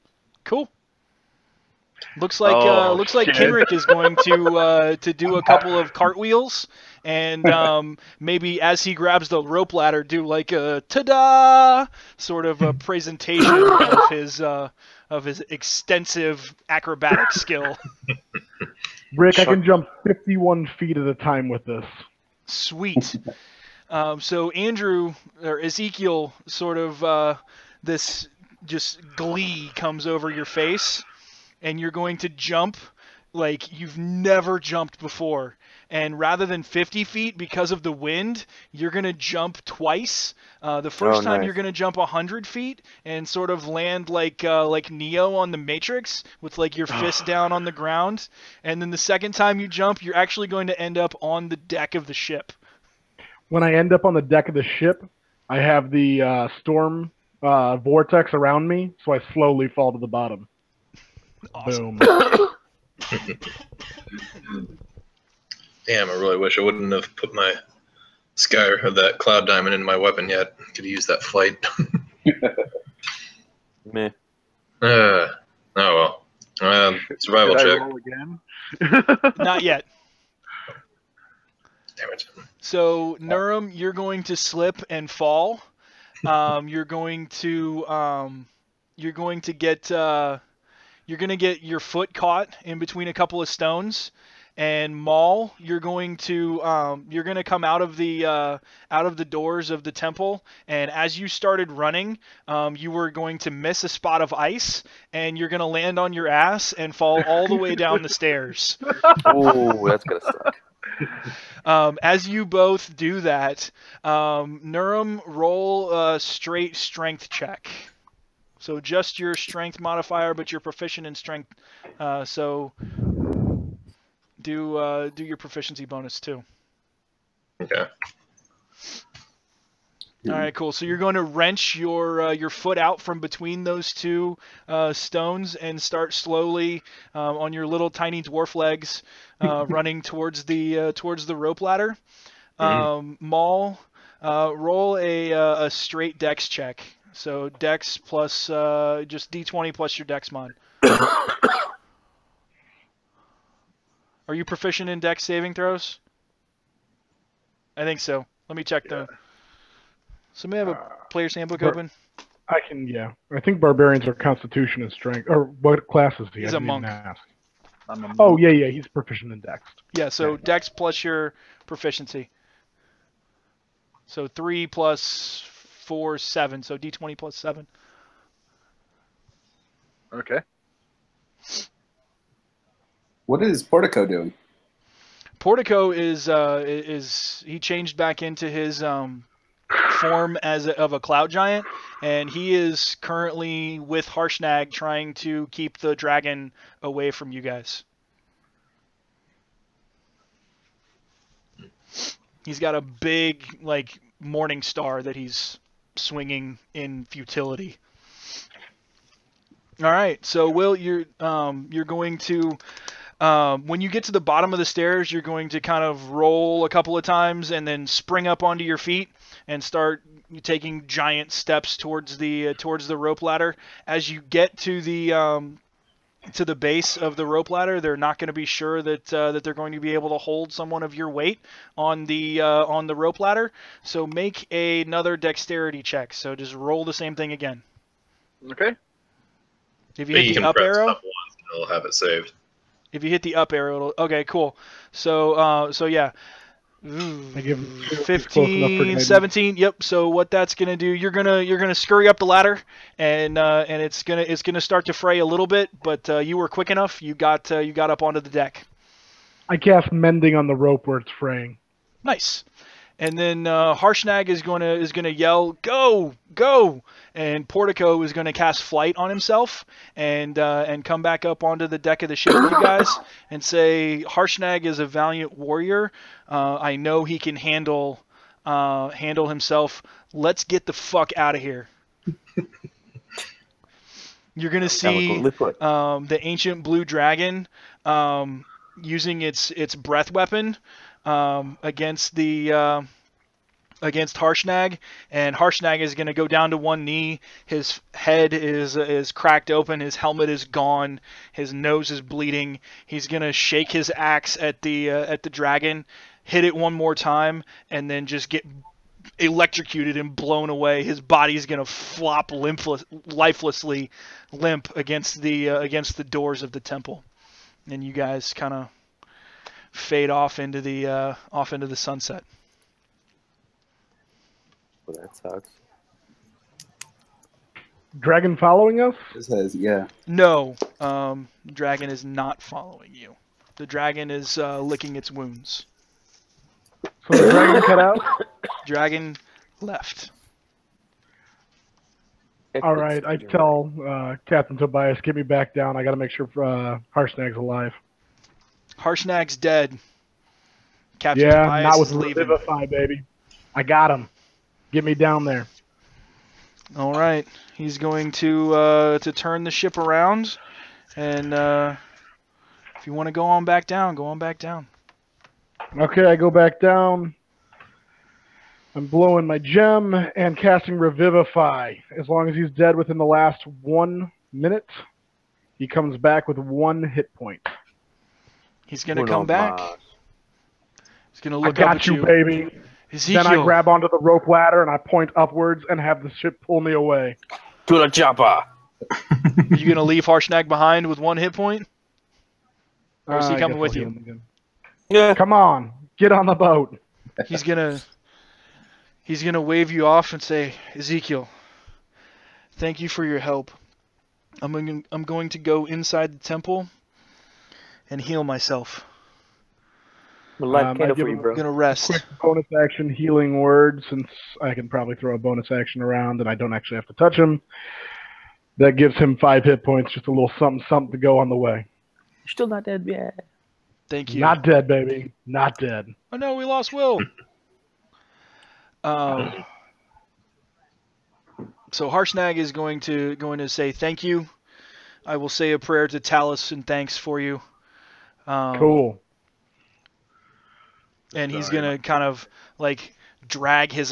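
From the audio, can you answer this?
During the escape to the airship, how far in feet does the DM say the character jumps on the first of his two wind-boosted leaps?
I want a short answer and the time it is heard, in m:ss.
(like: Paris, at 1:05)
100 feet, at 0:41.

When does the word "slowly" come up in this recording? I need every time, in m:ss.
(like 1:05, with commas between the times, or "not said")
0:59, 2:16.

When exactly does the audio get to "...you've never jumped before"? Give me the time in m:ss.
0:33.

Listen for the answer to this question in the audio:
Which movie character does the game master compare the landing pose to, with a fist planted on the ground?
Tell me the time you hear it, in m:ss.
0:44.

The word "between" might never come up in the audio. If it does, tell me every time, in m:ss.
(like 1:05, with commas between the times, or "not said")
1:32, 2:13.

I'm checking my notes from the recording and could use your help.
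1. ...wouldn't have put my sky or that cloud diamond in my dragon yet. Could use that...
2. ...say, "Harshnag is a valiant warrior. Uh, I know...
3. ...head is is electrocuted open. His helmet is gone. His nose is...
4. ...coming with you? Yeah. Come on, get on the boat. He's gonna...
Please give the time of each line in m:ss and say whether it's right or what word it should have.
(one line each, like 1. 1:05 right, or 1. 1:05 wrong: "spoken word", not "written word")
1. 1:06 wrong: "weapon", not "dragon"
2. 4:33 right
3. 4:57 wrong: "cracked", not "electrocuted"
4. 6:33 right.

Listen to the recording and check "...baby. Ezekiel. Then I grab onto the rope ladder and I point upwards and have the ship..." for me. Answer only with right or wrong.
right.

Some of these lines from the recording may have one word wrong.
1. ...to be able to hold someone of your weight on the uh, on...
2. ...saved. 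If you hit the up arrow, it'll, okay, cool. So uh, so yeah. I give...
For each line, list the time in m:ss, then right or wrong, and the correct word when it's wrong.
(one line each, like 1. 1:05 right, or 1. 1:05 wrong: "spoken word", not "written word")
1. 3:49 right
2. 4:01 right.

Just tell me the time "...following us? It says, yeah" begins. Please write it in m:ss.
5:28.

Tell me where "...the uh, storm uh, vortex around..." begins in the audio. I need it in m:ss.
0:55.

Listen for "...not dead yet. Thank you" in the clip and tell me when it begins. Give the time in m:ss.
7:02.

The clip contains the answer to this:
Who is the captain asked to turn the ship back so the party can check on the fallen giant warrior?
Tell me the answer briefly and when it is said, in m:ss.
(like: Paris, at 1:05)
Captain Tobias, at 5:44.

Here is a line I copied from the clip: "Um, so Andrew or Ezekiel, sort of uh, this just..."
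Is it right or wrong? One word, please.
right.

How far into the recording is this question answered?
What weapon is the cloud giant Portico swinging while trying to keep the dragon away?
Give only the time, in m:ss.
3:24.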